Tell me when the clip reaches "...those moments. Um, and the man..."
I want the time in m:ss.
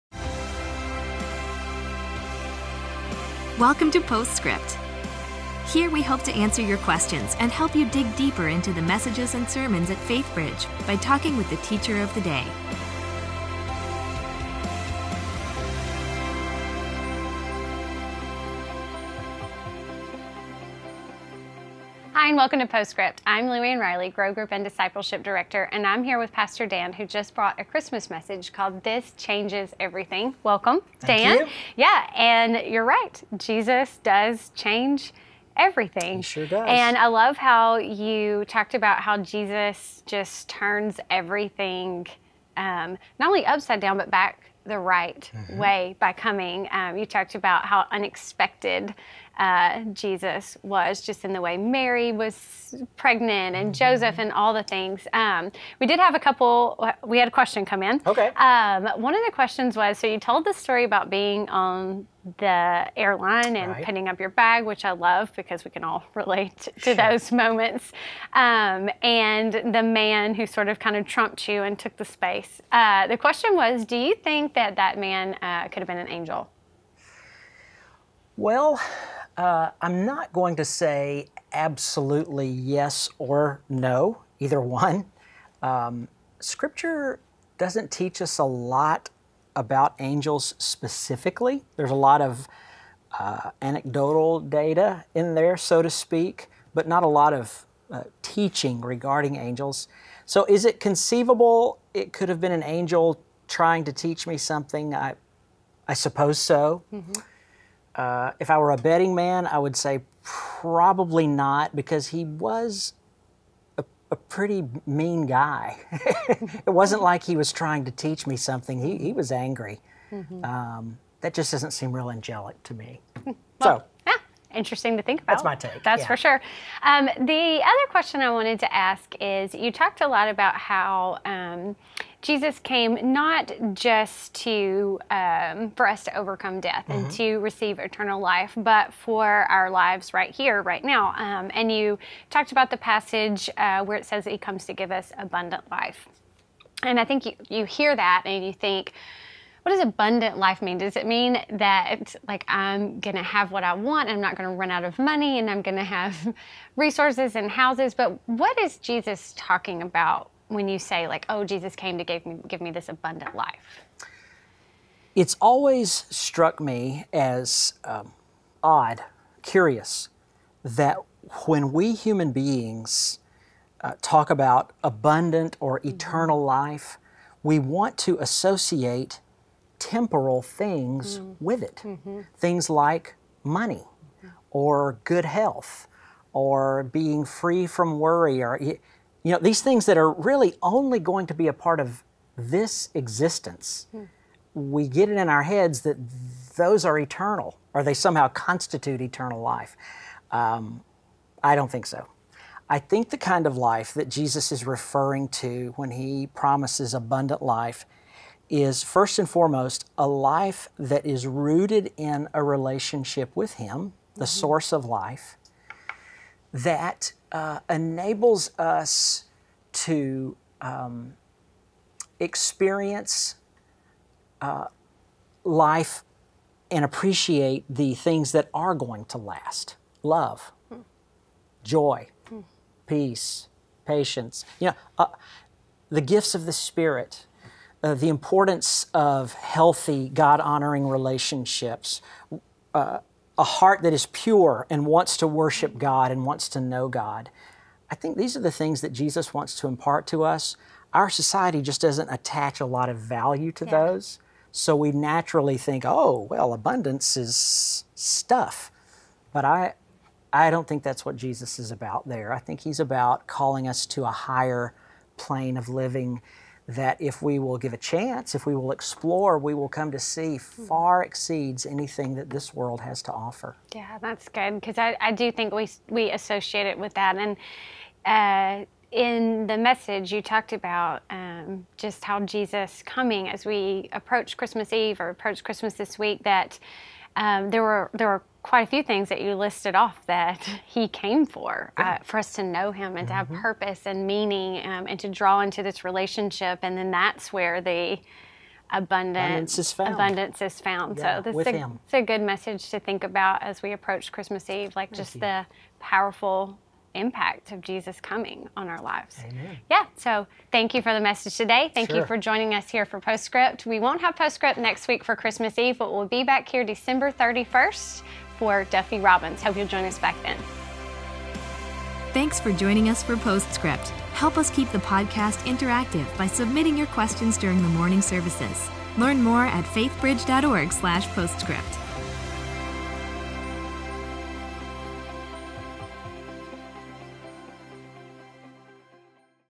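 1:06.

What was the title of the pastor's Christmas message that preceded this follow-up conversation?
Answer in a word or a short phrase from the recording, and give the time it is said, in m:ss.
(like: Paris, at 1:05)
This Changes Everything, at 0:28.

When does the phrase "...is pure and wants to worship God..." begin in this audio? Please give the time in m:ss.
4:03.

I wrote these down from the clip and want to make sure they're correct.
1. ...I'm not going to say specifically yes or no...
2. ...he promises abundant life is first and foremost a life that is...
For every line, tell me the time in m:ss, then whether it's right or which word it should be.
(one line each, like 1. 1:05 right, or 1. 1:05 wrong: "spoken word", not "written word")
1. 1:19 wrong: "absolutely", not "specifically"
2. 3:25 right.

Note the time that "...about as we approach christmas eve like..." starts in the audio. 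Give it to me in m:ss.
5:03.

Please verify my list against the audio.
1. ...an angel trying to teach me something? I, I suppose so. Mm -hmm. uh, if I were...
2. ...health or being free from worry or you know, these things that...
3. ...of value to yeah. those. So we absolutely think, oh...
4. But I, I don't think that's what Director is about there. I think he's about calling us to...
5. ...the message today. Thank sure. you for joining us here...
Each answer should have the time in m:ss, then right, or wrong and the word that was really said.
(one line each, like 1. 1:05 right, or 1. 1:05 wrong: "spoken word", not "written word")
1. 1:42 right
2. 3:05 right
3. 4:12 wrong: "naturally", not "absolutely"
4. 4:19 wrong: "Jesus", not "Director"
5. 5:10 right.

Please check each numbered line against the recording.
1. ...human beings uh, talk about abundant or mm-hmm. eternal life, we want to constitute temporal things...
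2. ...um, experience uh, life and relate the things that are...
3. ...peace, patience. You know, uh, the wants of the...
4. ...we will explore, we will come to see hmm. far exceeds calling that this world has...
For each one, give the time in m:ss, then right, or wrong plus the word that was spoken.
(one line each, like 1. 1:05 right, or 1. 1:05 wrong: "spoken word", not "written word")
1. 2:51 wrong: "associate", not "constitute"
2. 3:40 wrong: "appreciate", not "relate"
3. 3:52 wrong: "gifts", not "wants"
4. 4:28 wrong: "anything", not "calling".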